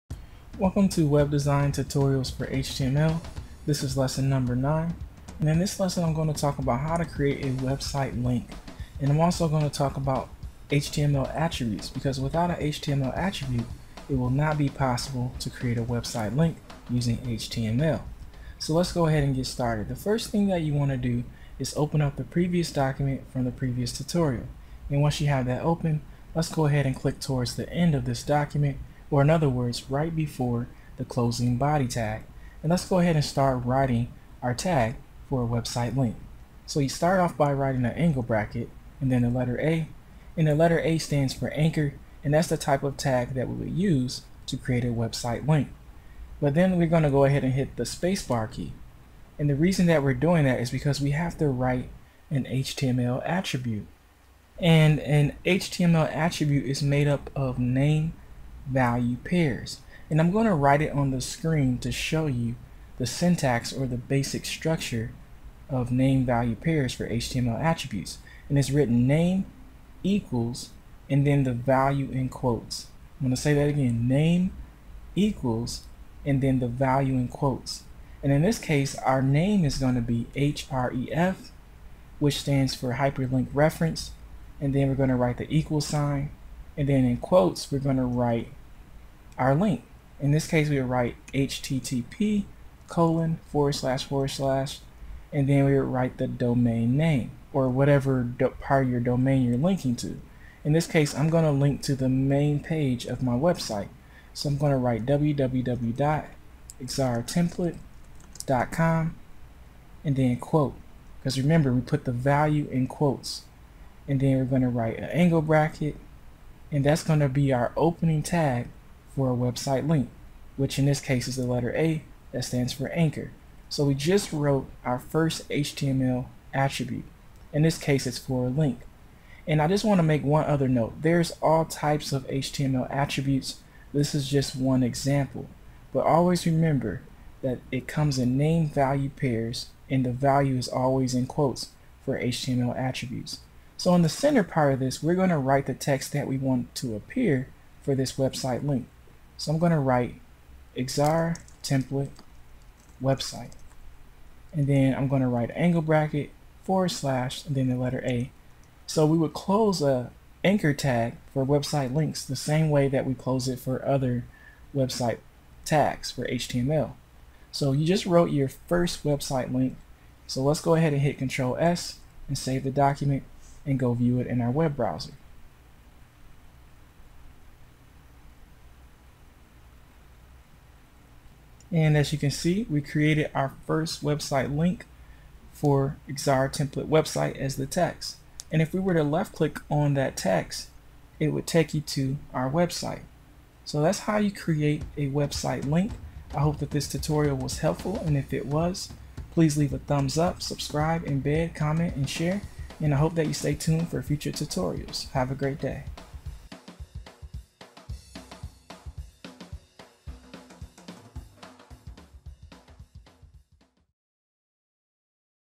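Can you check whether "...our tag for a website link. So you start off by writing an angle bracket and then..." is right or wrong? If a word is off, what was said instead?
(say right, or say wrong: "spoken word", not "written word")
right.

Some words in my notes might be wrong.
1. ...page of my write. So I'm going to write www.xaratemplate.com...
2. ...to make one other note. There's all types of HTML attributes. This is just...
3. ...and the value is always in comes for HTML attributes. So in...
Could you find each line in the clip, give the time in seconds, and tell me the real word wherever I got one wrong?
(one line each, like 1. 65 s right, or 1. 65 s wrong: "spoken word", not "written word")
1. 102 s wrong: "website", not "write"
2. 129 s right
3. 139 s wrong: "quotes", not "comes".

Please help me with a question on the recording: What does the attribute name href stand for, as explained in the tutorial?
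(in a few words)
hyperlink reference.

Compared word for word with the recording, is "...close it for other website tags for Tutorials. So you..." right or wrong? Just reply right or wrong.
wrong.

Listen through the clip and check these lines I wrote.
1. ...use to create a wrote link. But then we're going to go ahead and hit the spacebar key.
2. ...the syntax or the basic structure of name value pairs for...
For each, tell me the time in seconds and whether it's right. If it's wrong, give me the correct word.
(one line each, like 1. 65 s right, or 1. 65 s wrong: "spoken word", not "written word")
1. 43 s wrong: "website", not "wrote"
2. 62 s right.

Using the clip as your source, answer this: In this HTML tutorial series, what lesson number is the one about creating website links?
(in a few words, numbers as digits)
9.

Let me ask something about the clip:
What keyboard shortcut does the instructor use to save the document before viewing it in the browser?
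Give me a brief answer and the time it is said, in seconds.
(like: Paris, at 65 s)
Control S, at 171 s.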